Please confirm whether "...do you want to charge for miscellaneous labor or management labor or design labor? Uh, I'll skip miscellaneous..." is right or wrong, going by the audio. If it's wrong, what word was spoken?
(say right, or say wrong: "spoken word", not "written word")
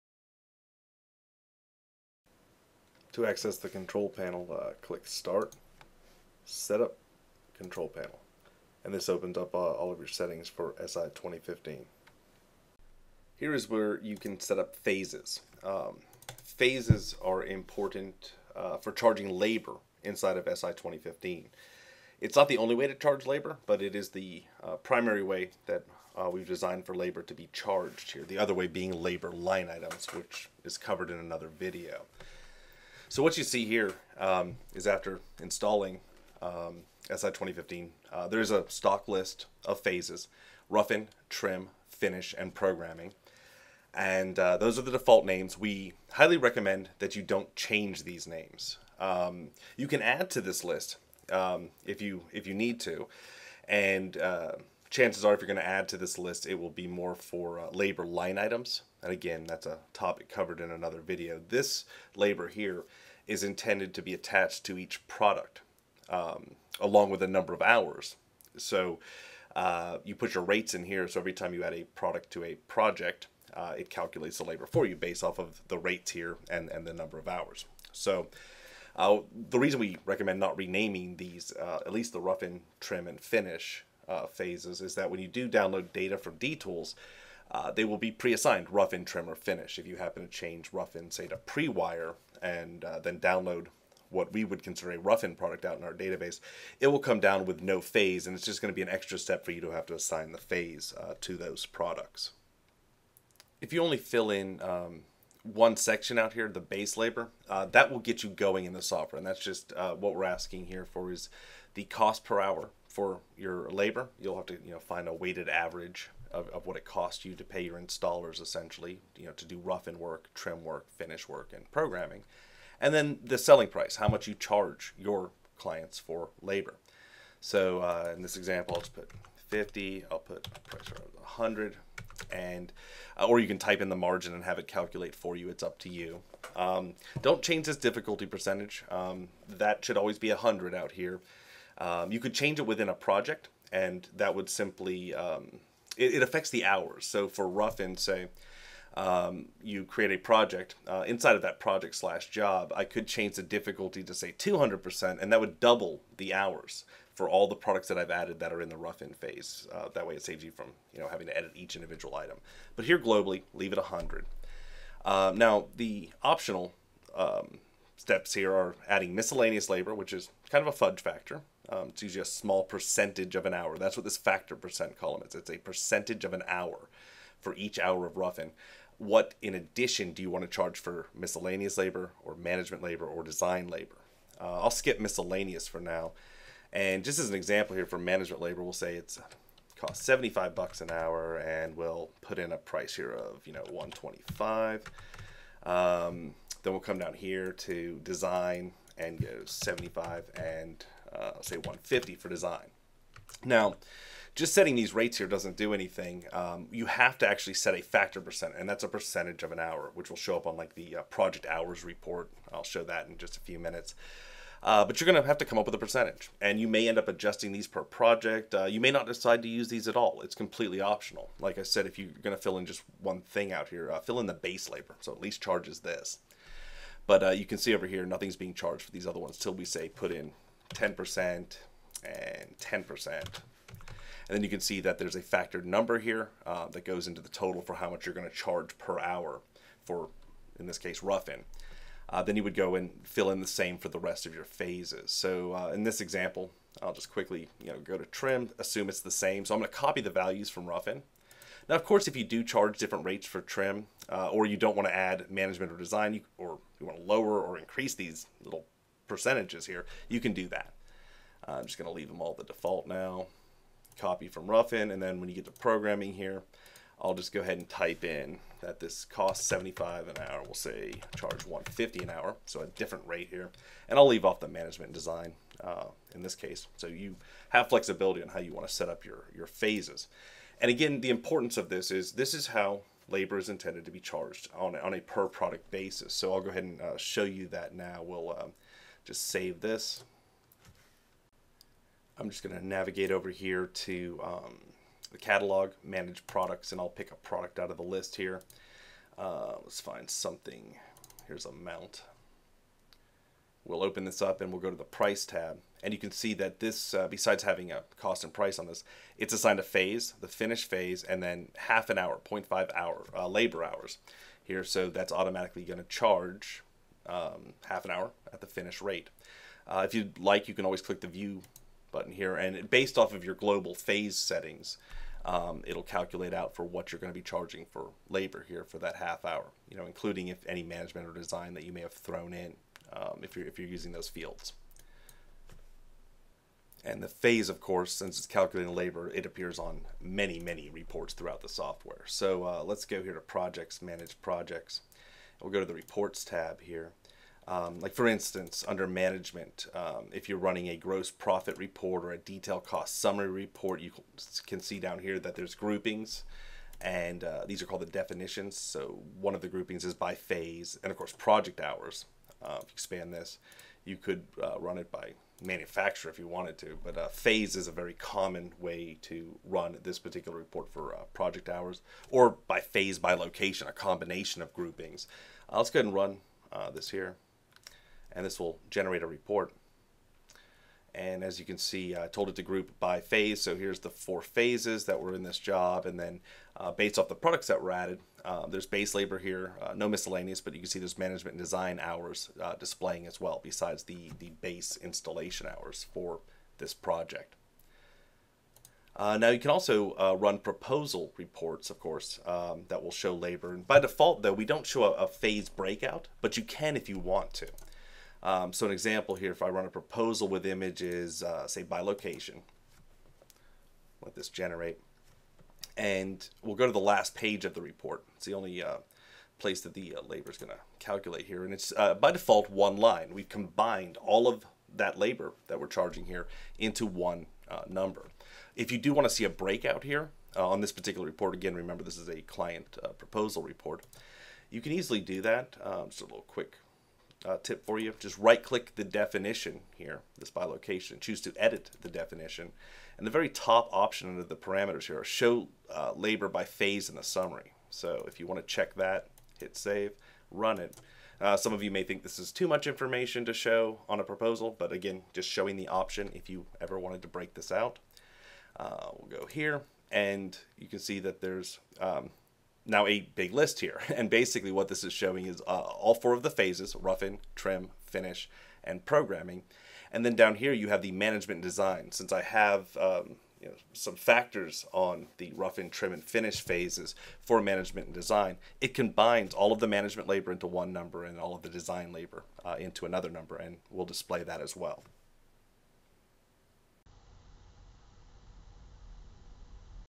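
right.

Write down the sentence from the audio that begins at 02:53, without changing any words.
That's what this factor percent column is.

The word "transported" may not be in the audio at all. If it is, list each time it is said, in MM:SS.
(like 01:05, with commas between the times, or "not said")
not said.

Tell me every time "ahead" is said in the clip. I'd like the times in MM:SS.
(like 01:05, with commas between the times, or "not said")
04:27, 04:46, 06:15.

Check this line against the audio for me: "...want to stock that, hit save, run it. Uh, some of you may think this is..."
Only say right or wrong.
wrong.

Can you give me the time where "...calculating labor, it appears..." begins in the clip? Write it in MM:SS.
05:38.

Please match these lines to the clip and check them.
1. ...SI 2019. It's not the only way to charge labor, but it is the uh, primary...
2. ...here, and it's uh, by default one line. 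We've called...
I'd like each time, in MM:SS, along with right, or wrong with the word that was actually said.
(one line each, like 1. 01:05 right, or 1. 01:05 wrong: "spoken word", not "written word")
1. 00:20 wrong: "2015", not "2019"
2. 07:01 wrong: "combined", not "called".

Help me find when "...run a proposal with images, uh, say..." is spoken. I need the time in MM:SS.
06:49.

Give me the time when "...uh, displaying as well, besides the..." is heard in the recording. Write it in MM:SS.
06:32.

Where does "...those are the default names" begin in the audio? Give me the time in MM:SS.
00:44.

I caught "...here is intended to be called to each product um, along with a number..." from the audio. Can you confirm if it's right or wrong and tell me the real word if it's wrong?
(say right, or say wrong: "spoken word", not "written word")
wrong: "attached", not "called".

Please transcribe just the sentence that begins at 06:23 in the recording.
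So here's the four phases that were in this job.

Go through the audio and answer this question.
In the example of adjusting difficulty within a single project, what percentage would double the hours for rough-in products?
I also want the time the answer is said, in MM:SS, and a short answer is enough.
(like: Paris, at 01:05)
200%, at 02:34.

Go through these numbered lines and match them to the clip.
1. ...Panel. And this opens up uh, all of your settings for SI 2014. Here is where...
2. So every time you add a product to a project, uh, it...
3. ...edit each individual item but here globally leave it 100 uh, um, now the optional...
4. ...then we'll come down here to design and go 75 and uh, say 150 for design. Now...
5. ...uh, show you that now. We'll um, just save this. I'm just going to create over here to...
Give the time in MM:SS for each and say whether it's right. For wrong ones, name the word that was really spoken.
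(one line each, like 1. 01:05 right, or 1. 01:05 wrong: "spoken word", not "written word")
1. 00:07 wrong: "2015", not "2014"
2. 01:11 right
3. 02:41 right
4. 03:16 right
5. 04:46 wrong: "navigate", not "create".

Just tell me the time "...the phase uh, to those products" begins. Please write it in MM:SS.
01:40.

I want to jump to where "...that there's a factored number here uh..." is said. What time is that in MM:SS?
03:54.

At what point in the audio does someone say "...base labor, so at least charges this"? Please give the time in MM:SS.
03:44.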